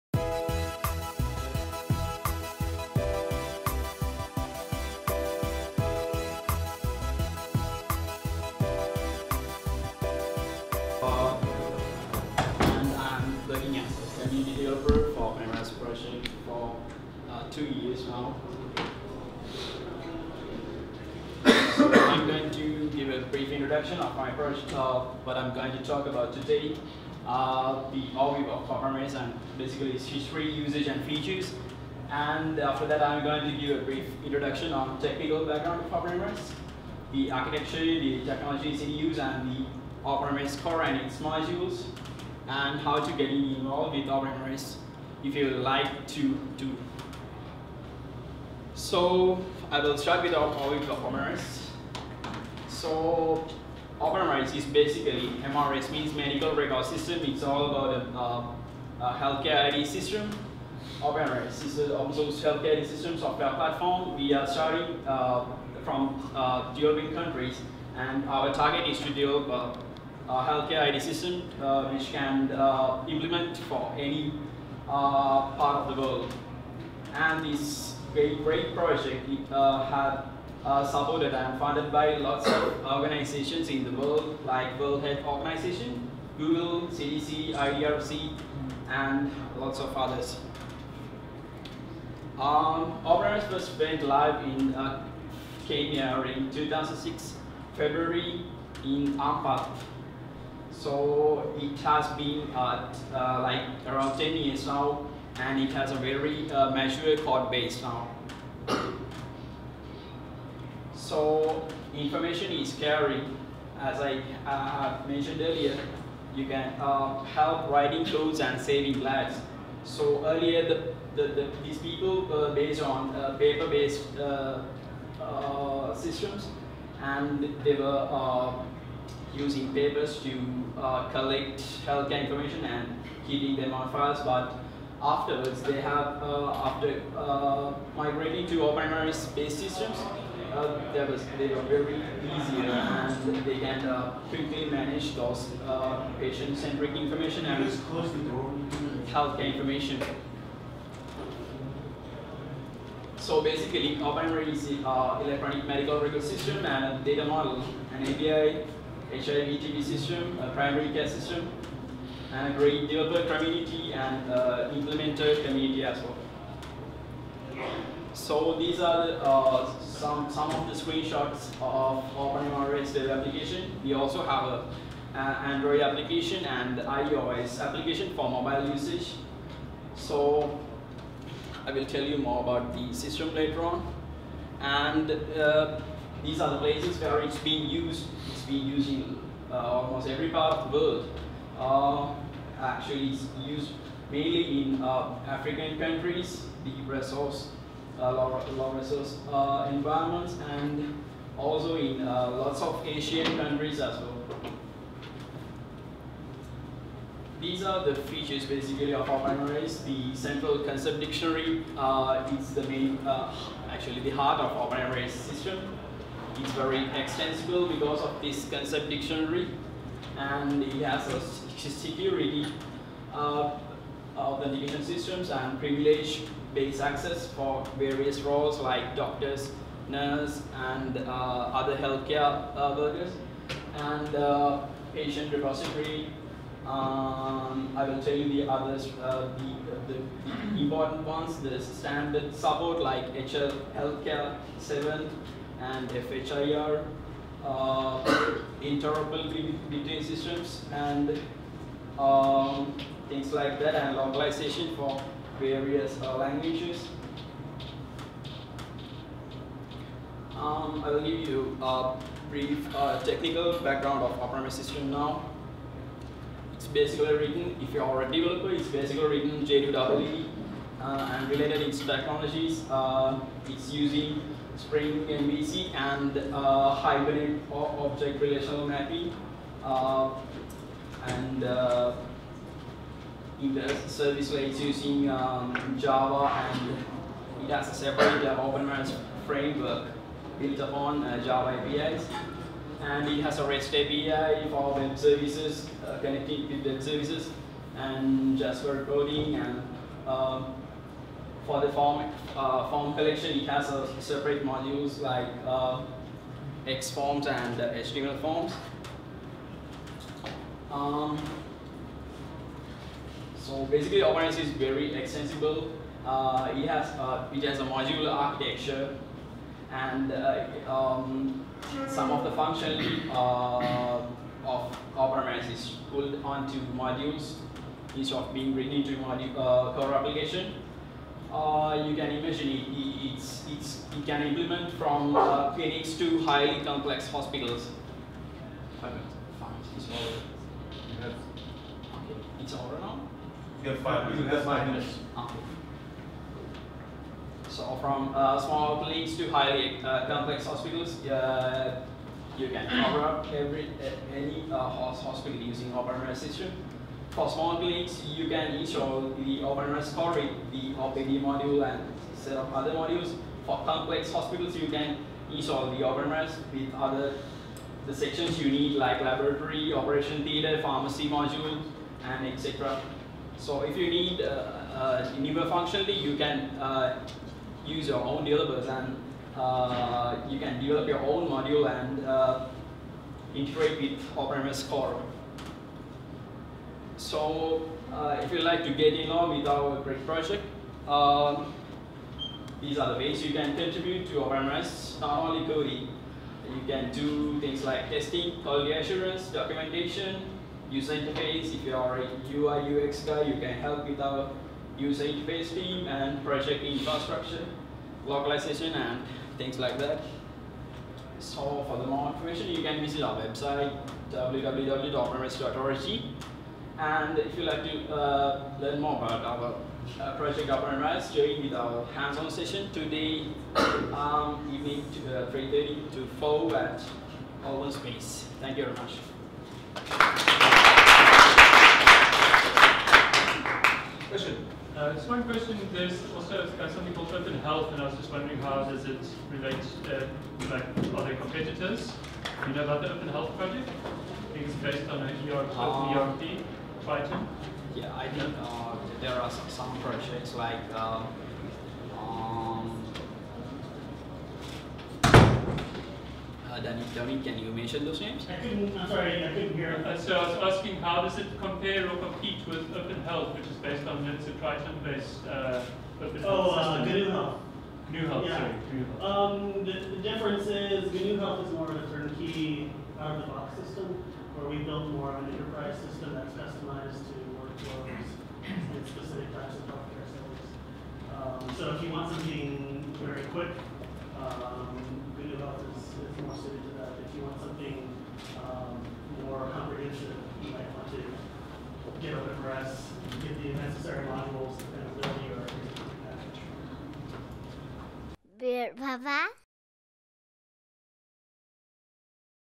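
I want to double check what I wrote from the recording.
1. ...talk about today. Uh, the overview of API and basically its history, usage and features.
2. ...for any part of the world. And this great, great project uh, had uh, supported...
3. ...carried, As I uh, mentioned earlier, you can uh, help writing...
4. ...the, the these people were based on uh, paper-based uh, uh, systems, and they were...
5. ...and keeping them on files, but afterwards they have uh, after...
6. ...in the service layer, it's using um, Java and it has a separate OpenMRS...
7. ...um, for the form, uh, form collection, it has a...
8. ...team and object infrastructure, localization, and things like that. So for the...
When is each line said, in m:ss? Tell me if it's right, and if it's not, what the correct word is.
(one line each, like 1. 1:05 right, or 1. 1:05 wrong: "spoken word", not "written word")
1. 0:25 wrong: "OpenMRS", not "API"
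2. 1:13 right
3. 1:52 right
4. 2:01 right
5. 2:12 right
6. 4:43 right
7. 5:00 right
8. 6:45 wrong: "project", not "object".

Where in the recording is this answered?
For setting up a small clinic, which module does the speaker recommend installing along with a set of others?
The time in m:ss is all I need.
6:00.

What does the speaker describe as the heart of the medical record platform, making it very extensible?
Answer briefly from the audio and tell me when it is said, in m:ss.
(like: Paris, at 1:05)
central concept dictionary, at 3:30.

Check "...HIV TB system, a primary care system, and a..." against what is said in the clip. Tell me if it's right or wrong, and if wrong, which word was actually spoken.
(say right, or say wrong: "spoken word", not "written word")
right.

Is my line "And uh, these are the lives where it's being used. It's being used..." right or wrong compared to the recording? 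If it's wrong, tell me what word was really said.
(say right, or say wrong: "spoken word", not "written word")
wrong: "places", not "lives".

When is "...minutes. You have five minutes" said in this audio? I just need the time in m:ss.
5:44.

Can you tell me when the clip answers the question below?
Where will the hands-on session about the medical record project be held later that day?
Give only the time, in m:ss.
7:07.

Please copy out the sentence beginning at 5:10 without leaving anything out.
Um, so basically, OpenMRS is very extensible.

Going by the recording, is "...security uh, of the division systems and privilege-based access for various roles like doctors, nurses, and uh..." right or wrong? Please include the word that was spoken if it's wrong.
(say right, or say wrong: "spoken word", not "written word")
right.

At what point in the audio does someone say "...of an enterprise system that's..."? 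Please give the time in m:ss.
7:55.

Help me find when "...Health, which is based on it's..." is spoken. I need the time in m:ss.
7:43.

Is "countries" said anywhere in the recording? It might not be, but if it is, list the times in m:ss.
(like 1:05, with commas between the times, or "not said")
1:07, 3:15, 3:23.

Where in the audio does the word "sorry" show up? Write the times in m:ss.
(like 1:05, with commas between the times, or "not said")
7:38, 7:48.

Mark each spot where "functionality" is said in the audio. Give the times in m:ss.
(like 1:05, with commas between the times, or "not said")
5:22, 6:15.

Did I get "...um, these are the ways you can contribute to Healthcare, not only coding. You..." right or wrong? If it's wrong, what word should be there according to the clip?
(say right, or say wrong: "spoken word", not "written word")
wrong: "OpenMRS", not "Healthcare".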